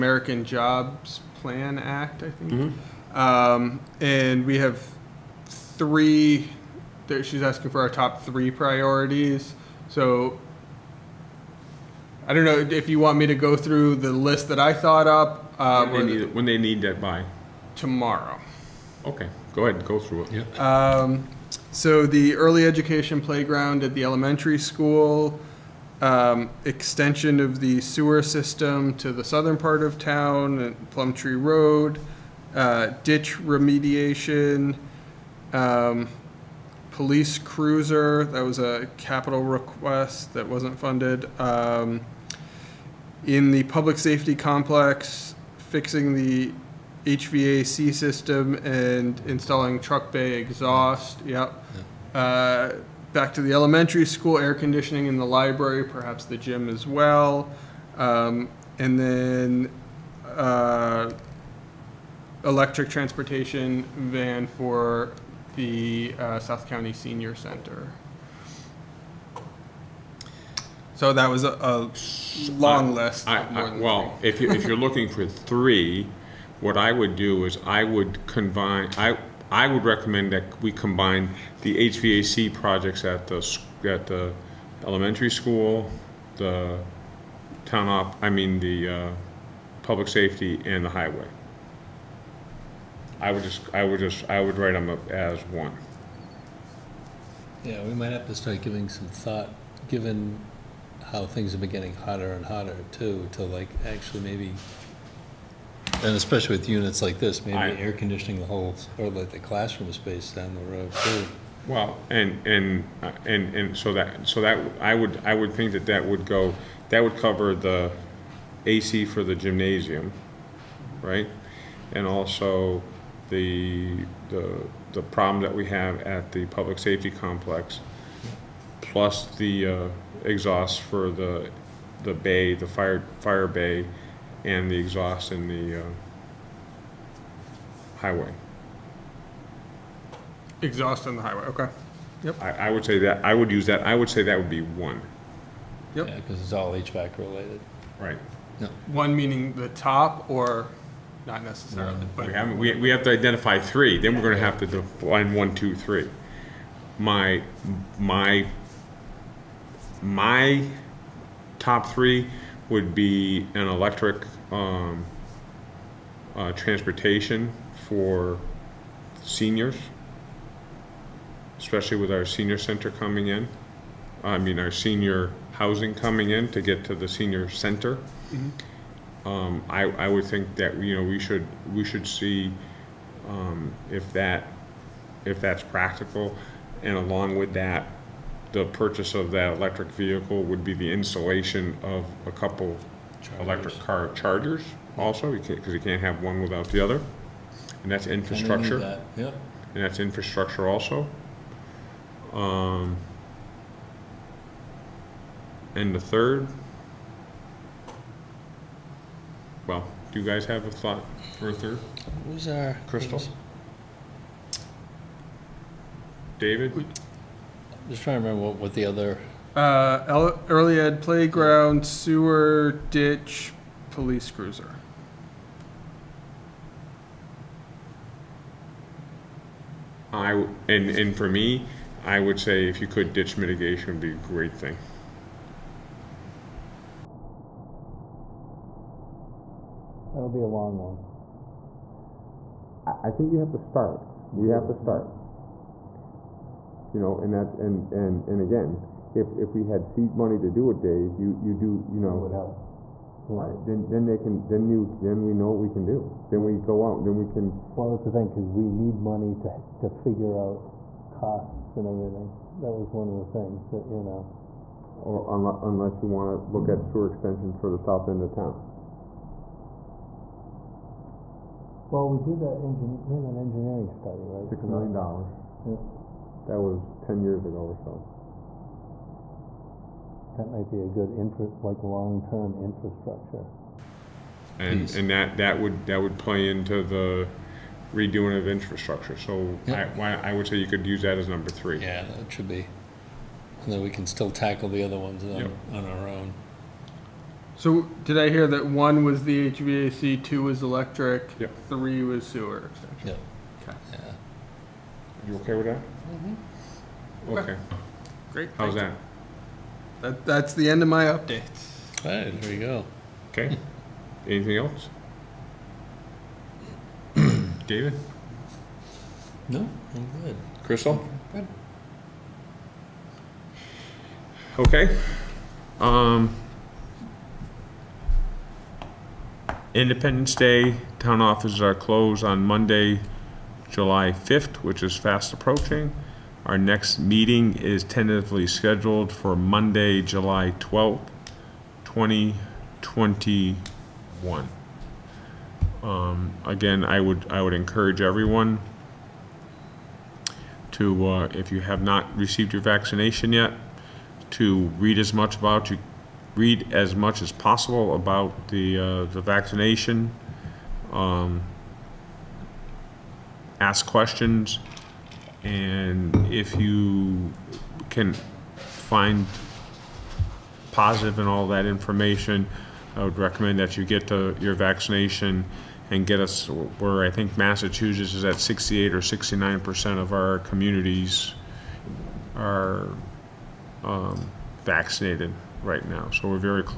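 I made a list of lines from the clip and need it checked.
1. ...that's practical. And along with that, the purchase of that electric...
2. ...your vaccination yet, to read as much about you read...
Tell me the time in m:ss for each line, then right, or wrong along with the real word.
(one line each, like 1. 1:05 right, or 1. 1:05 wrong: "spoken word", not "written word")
1. 3:05 right
2. 5:52 right.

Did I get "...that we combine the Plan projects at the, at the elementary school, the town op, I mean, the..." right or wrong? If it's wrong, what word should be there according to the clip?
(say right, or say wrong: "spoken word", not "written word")
wrong: "HVAC", not "Plan".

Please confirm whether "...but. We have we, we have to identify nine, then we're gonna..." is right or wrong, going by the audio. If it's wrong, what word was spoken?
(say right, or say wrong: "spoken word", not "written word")
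wrong: "three", not "nine".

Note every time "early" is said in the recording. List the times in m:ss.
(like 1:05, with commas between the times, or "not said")
0:22, 3:40.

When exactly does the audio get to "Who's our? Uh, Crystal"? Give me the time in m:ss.
3:32.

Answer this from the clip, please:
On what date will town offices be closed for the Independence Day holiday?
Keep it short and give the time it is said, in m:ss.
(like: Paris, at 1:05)
Monday, July 5th, at 5:32.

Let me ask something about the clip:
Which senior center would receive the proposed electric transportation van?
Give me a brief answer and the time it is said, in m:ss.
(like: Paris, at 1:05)
South County Senior Center, at 1:06.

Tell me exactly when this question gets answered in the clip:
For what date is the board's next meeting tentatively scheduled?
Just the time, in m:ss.
5:39.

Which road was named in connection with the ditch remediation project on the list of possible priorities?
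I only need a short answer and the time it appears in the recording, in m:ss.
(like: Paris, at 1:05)
Plum Tree Road, at 0:30.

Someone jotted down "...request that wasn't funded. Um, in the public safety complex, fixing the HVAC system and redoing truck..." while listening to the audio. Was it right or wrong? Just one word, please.
wrong.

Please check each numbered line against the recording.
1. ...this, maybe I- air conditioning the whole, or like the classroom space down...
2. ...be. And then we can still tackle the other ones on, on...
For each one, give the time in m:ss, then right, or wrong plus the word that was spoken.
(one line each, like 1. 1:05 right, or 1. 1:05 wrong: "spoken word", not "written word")
1. 1:47 right
2. 4:52 right.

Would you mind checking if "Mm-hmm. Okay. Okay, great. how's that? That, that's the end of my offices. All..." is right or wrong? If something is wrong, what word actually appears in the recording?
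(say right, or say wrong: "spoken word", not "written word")
wrong: "updates", not "offices".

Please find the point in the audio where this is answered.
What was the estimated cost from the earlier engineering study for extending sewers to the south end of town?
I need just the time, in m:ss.
4:34.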